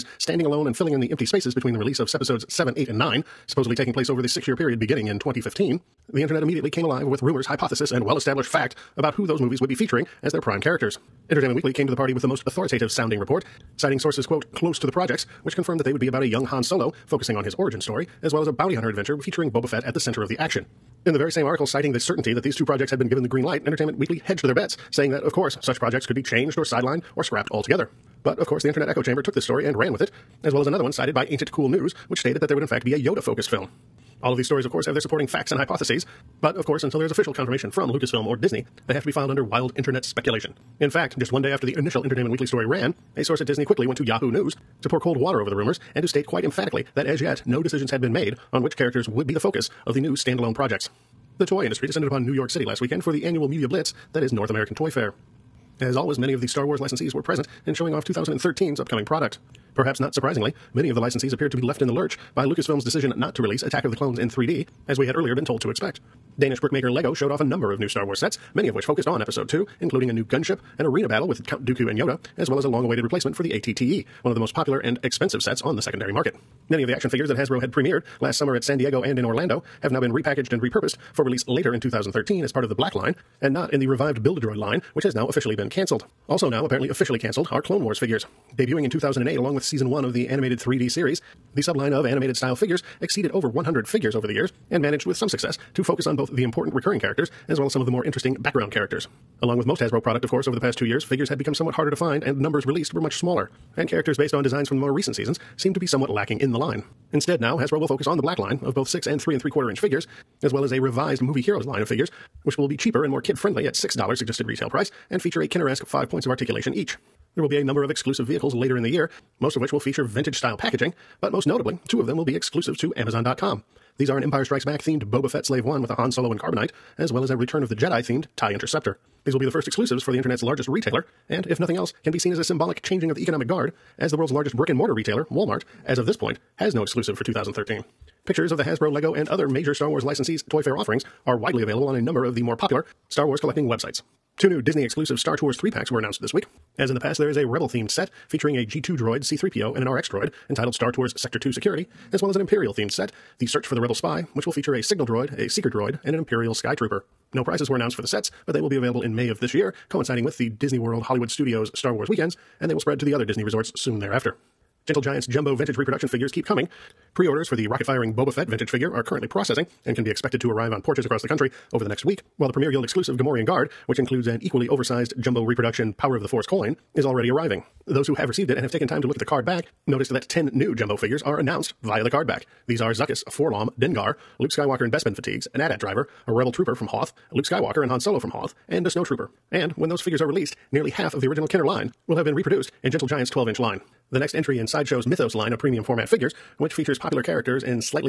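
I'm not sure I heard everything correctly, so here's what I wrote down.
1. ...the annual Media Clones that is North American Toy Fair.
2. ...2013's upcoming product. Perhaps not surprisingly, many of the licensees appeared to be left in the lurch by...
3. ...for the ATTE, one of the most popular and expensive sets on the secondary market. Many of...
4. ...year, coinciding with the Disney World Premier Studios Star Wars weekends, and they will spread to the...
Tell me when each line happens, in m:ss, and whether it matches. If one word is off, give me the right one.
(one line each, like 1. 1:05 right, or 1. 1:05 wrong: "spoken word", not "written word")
1. 0:53 wrong: "Blitz", not "Clones"
2. 0:58 right
3. 1:13 right
4. 2:39 wrong: "Hollywood", not "Premier".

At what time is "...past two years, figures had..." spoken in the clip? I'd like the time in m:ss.
1:40.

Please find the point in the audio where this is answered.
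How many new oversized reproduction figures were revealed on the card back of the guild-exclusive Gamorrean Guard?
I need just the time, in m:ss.
3:00.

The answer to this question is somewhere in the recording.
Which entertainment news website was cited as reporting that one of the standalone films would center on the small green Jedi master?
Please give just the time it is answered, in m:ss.
0:31.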